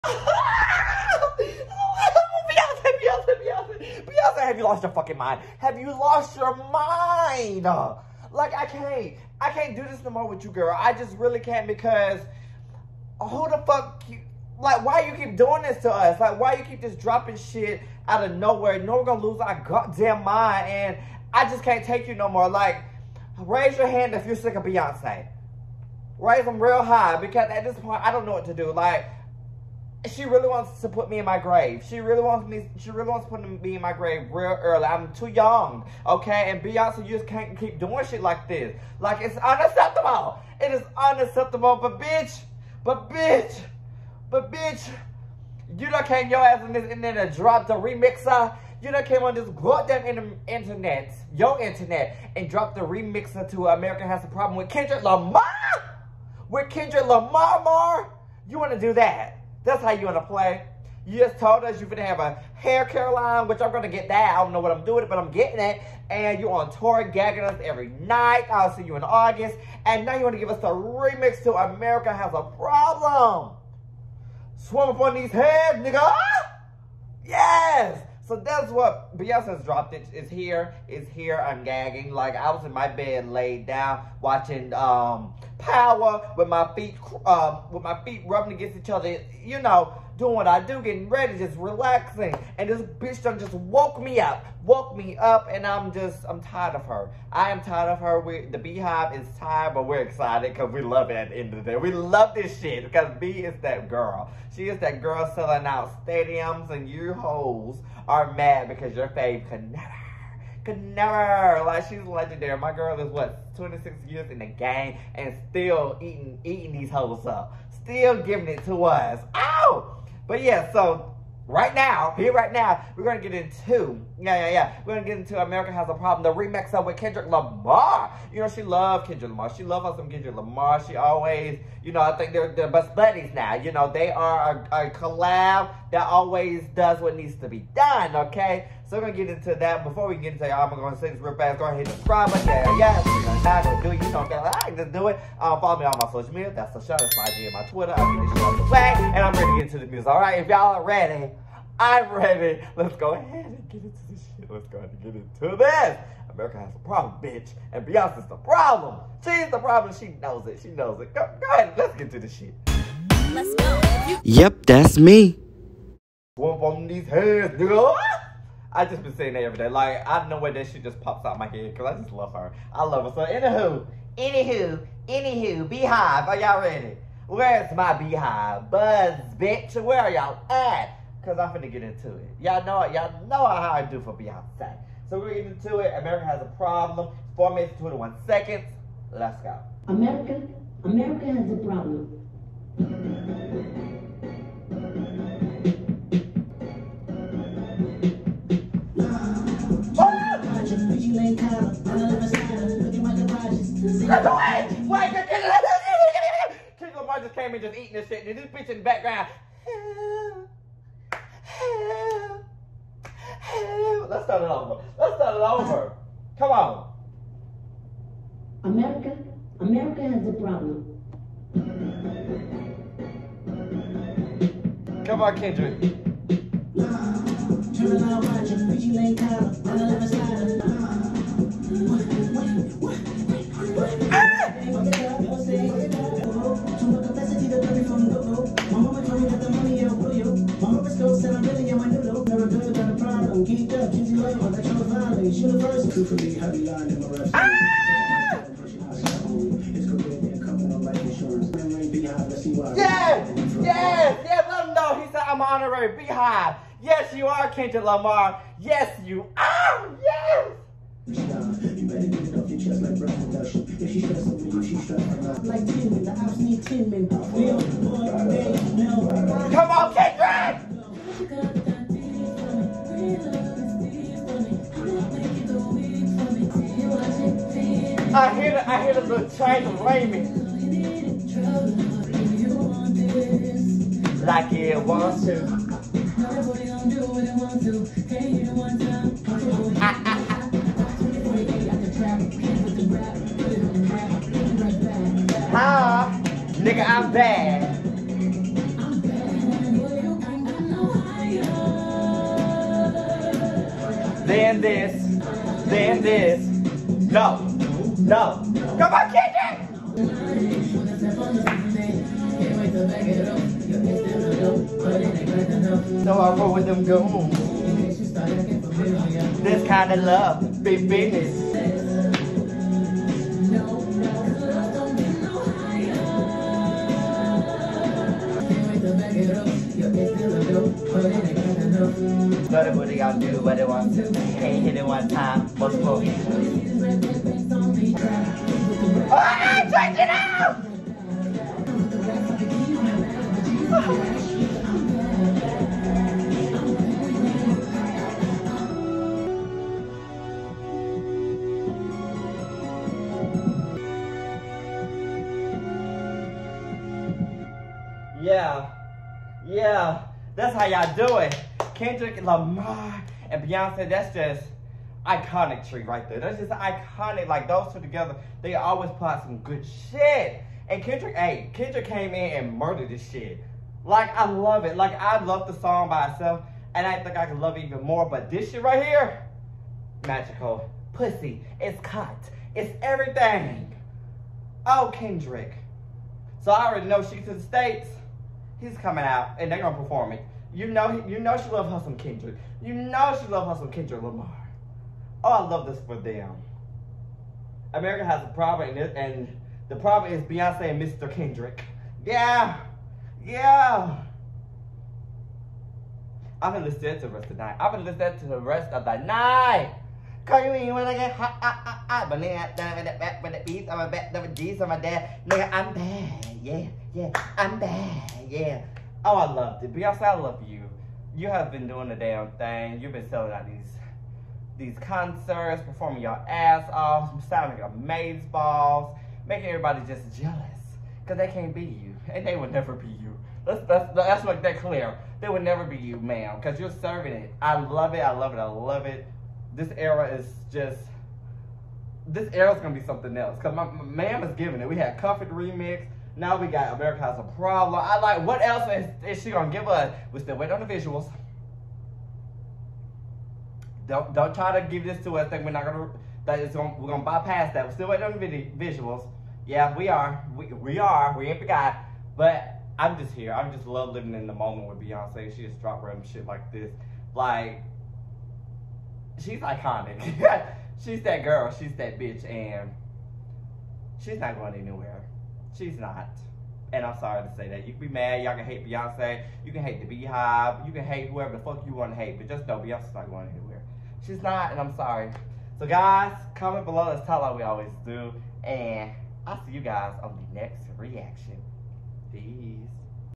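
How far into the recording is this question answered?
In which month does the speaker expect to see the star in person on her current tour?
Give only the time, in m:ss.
1:09.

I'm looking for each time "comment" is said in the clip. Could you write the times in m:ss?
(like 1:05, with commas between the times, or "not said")
8:06.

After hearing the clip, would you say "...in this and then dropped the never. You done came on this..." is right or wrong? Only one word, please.
wrong.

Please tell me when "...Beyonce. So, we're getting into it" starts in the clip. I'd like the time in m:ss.
3:04.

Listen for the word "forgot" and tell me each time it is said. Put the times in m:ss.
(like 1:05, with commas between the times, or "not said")
7:41.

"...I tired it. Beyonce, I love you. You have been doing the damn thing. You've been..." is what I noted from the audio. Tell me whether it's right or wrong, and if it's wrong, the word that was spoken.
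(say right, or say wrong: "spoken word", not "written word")
wrong: "loved", not "tired".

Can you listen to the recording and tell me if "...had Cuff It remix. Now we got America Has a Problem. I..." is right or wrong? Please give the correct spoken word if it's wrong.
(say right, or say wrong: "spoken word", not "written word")
right.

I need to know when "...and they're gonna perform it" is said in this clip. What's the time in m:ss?
6:29.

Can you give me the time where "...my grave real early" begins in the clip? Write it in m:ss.
0:33.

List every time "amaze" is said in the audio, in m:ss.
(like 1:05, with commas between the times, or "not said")
7:07.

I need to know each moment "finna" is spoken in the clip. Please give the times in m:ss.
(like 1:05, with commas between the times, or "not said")
3:01.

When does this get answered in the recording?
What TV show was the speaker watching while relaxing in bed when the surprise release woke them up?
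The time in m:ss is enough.
1:25.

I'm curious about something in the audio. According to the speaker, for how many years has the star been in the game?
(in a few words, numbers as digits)
26.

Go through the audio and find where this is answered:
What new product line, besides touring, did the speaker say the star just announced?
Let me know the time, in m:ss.
1:02.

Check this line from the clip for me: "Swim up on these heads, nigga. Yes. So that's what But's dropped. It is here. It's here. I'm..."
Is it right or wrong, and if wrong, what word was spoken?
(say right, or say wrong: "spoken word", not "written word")
wrong: "Beyonce", not "But".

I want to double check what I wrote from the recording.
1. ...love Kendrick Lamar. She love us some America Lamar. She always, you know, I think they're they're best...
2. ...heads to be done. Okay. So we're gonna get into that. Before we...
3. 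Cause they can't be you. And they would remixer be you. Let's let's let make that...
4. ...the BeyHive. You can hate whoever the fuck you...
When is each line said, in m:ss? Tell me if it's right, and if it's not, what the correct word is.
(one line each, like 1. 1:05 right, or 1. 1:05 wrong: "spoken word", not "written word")
1. 2:08 wrong: "Kendrick", not "America"
2. 2:17 wrong: "needs", not "heads"
3. 7:11 wrong: "never", not "remixer"
4. 7:59 right.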